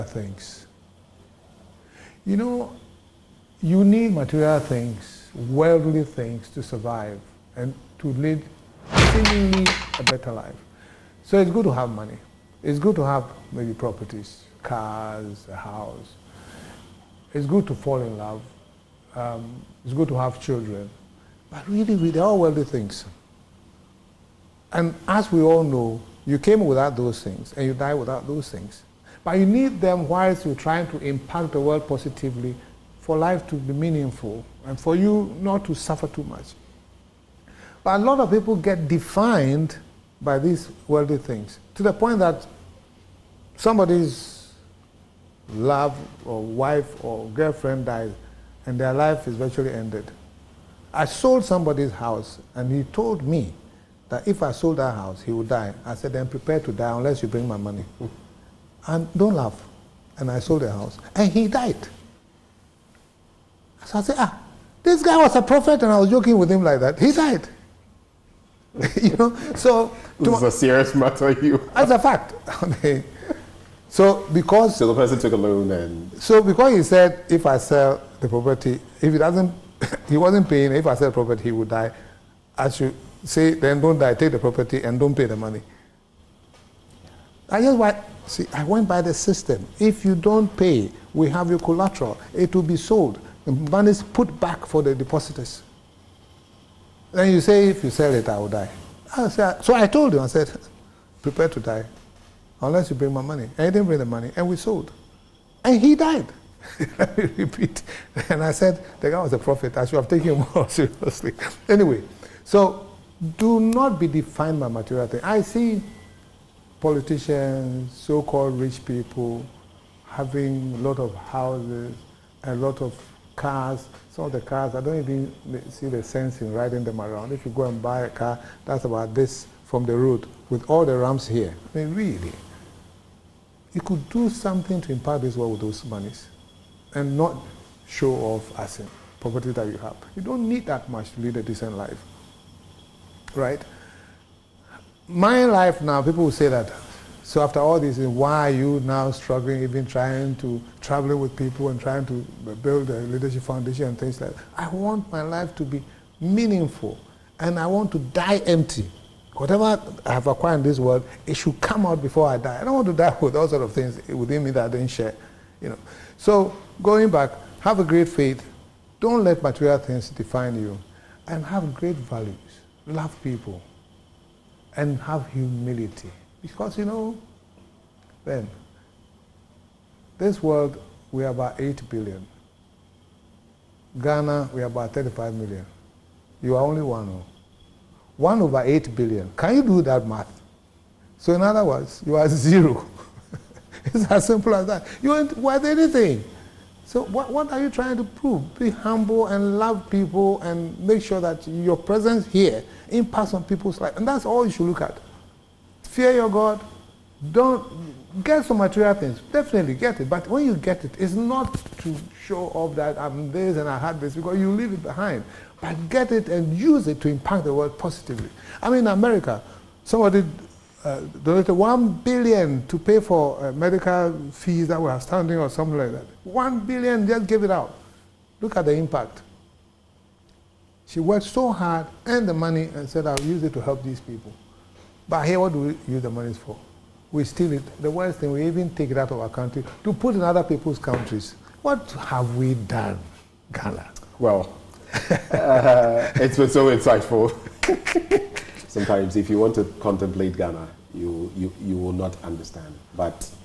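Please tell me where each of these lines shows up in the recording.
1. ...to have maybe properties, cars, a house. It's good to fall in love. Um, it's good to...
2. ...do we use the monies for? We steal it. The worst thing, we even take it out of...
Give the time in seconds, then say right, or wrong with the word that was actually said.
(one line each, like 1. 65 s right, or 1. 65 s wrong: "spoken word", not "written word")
1. 12 s right
2. 235 s right.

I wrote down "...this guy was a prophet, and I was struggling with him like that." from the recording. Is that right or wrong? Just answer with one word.
wrong.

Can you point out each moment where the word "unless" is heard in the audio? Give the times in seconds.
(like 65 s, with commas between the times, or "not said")
56 s, 102 s.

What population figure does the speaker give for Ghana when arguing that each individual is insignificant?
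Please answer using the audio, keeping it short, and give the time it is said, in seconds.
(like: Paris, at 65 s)
35 million, at 184 s.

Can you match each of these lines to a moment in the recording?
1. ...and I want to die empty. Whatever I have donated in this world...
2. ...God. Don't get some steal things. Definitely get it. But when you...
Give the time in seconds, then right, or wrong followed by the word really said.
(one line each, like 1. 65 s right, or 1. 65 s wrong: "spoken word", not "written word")
1. 157 s wrong: "acquired", not "donated"
2. 206 s wrong: "material", not "steal".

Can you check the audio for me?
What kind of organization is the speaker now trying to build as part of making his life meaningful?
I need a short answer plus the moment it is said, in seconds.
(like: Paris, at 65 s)
Leadership foundation, at 152 s.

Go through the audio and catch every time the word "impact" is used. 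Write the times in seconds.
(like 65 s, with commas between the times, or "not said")
30 s, 134 s, 202 s, 217 s, 228 s.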